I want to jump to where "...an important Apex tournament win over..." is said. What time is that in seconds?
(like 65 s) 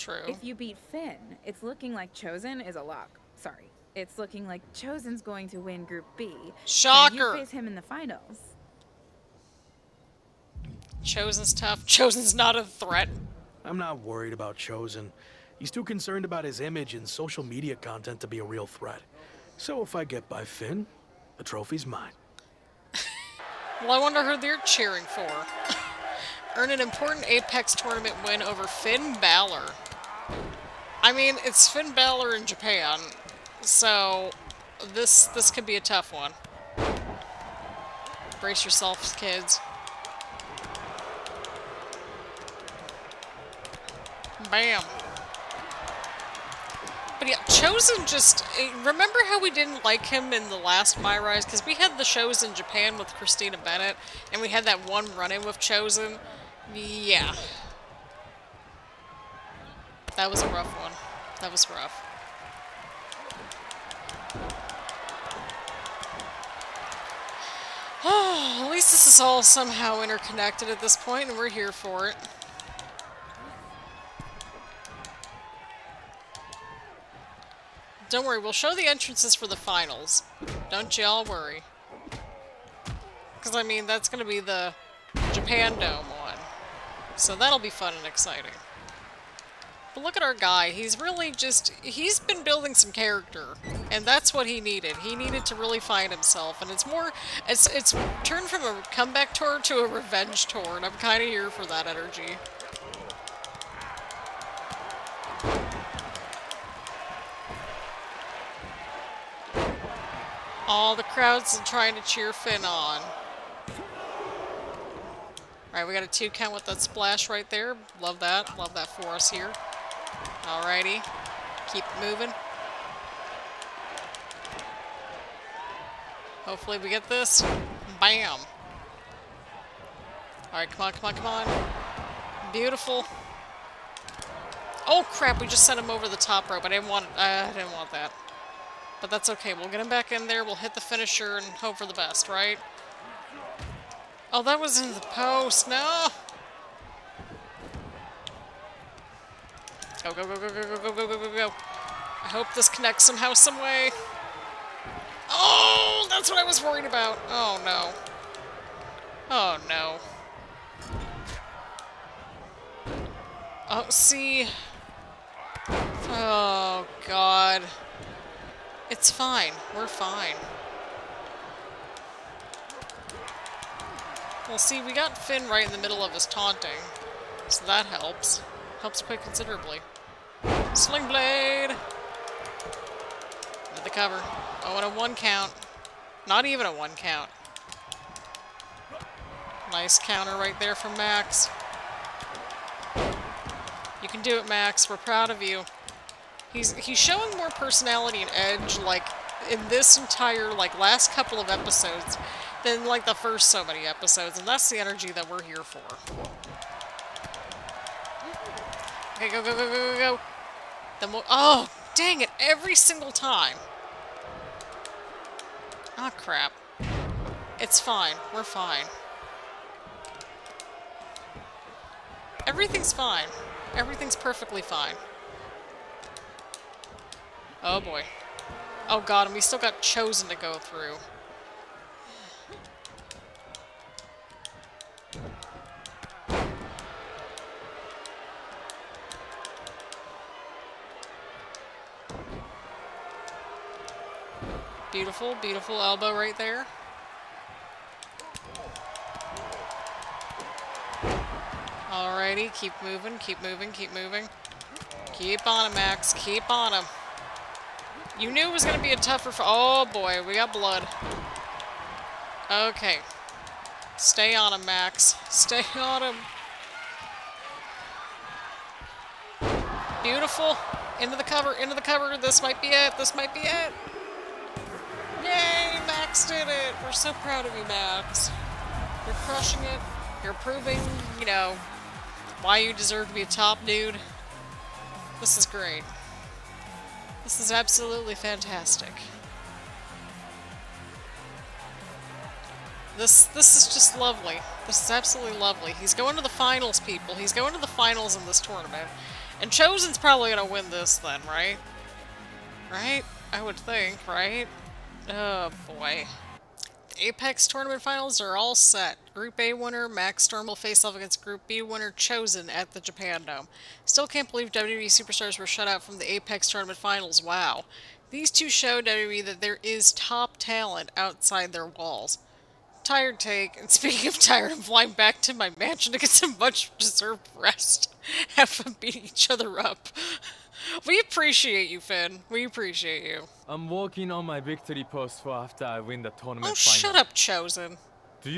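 26 s.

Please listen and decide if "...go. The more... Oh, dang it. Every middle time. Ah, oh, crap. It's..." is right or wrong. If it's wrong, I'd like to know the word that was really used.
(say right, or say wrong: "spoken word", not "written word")
wrong: "single", not "middle".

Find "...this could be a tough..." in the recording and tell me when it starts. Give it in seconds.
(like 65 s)
35 s.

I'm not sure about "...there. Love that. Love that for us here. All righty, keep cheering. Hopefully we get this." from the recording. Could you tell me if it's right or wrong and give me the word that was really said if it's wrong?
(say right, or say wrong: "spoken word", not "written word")
wrong: "moving", not "cheering".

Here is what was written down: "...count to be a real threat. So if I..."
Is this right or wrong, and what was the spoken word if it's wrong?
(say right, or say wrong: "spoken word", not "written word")
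wrong: "content", not "count".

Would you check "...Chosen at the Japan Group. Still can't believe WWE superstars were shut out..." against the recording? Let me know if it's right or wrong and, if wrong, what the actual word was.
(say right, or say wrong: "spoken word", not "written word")
wrong: "Dome", not "Group".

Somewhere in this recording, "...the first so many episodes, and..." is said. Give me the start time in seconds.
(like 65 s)
203 s.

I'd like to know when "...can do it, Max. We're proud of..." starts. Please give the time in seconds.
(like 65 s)
194 s.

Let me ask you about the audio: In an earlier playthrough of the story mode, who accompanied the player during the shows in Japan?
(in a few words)
Christina Bennett.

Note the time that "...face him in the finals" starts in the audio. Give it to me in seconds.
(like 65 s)
7 s.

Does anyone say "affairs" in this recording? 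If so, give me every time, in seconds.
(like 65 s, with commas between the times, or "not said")
not said.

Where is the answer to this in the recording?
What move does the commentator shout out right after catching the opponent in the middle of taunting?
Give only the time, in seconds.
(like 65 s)
180 s.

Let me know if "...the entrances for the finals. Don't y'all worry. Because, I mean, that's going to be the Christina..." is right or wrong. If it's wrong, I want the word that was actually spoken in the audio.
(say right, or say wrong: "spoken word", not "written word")
wrong: "Japan", not "Christina".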